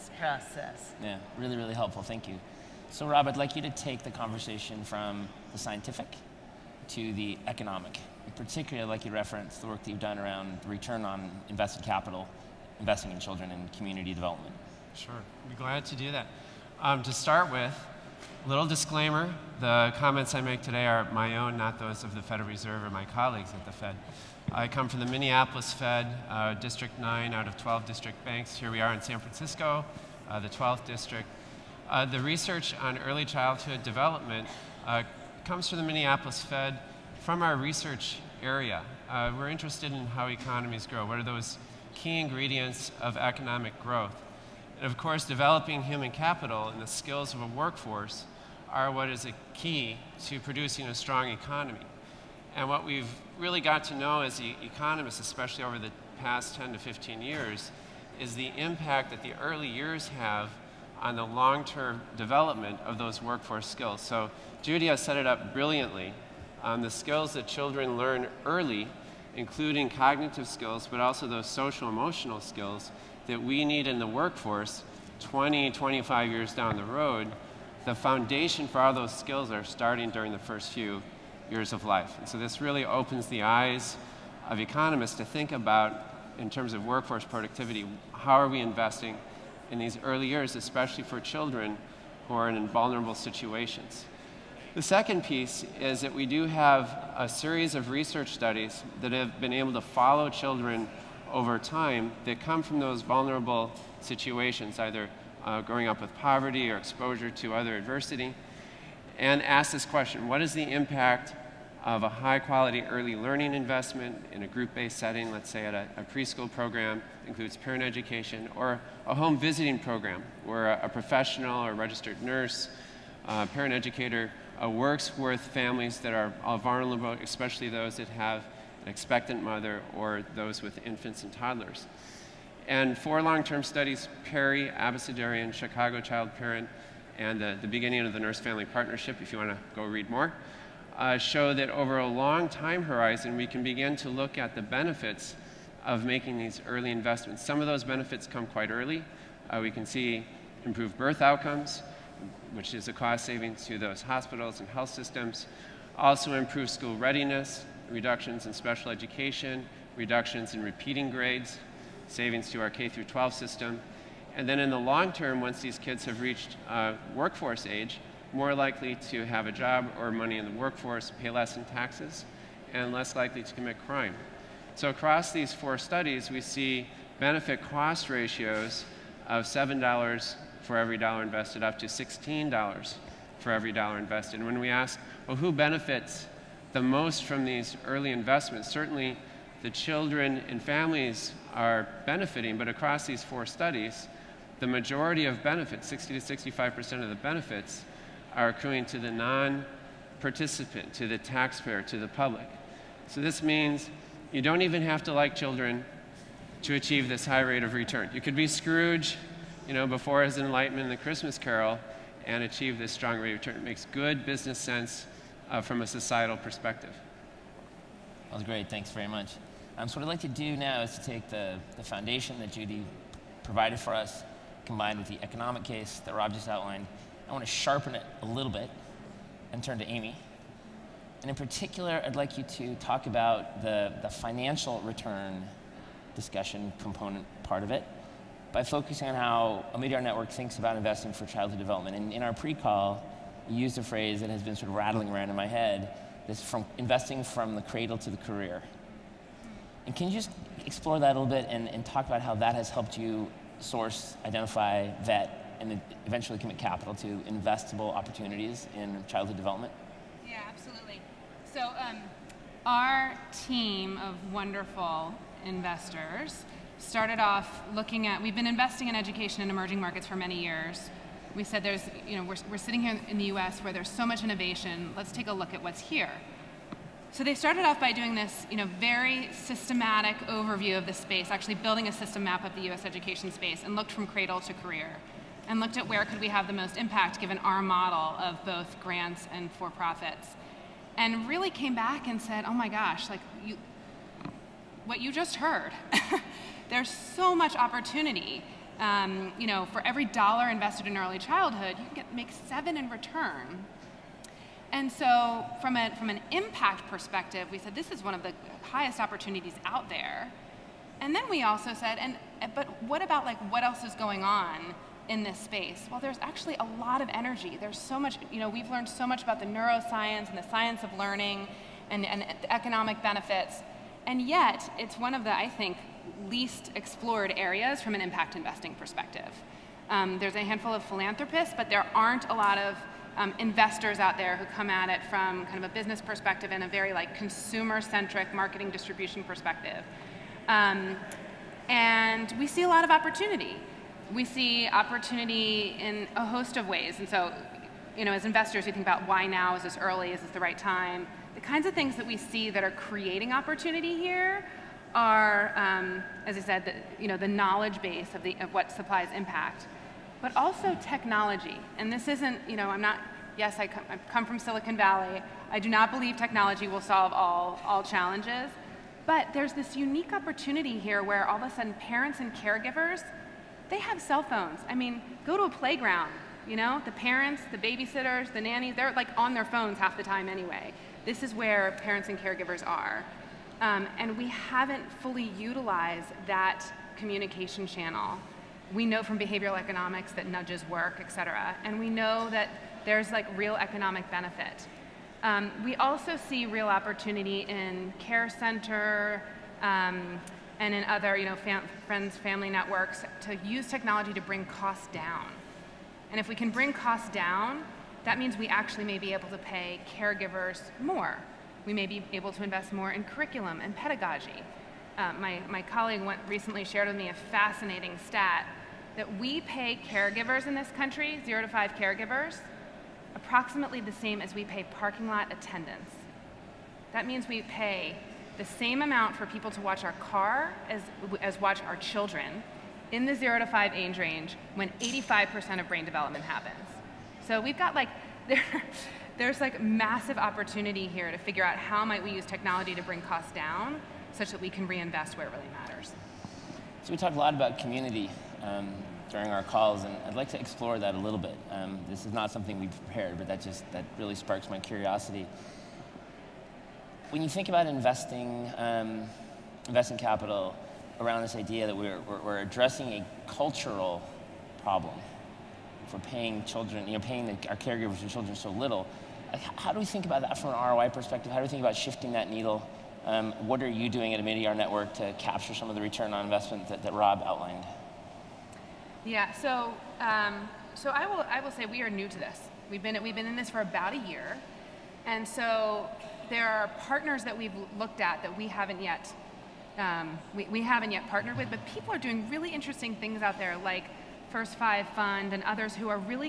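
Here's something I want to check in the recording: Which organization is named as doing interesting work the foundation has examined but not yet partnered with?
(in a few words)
First Five Fund.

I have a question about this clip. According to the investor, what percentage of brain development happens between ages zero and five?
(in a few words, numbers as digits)
85%.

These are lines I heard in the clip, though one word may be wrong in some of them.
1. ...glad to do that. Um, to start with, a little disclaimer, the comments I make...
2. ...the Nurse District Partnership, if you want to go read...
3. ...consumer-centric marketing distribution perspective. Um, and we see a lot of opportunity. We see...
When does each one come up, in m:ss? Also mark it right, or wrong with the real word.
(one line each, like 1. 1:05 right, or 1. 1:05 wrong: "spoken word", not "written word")
1. 0:15 right
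2. 2:18 wrong: "Family", not "District"
3. 5:37 right.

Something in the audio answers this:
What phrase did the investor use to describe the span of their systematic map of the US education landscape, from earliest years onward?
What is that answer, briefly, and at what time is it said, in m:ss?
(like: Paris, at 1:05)
from the cradle to the career, at 4:07.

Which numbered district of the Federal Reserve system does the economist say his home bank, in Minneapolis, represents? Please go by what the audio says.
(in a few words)
District 9.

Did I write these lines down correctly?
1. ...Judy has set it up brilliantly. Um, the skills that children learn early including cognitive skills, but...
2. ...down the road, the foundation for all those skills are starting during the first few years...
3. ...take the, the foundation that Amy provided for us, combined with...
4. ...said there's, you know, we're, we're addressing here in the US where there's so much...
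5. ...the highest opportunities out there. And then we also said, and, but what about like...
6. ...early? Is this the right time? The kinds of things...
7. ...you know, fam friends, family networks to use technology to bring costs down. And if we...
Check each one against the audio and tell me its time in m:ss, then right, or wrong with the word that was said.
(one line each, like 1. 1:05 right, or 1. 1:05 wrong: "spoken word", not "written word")
1. 1:04 right
2. 1:16 right
3. 3:41 wrong: "Judy", not "Amy"
4. 4:31 wrong: "sitting", not "addressing"
5. 5:08 right
6. 5:49 right
7. 6:41 right.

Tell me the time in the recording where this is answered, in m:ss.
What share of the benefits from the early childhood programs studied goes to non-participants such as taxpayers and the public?
3:15.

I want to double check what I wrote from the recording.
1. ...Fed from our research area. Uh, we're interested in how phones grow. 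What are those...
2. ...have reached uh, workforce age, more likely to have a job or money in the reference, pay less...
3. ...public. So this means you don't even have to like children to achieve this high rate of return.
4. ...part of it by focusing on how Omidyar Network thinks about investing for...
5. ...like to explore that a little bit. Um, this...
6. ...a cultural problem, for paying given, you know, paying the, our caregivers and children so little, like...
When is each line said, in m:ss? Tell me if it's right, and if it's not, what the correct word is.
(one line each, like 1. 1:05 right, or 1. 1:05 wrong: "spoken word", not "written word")
1. 0:36 wrong: "economies", not "phones"
2. 2:46 wrong: "workforce", not "reference"
3. 3:22 right
4. 3:57 right
5. 7:30 right
6. 7:42 wrong: "children", not "given".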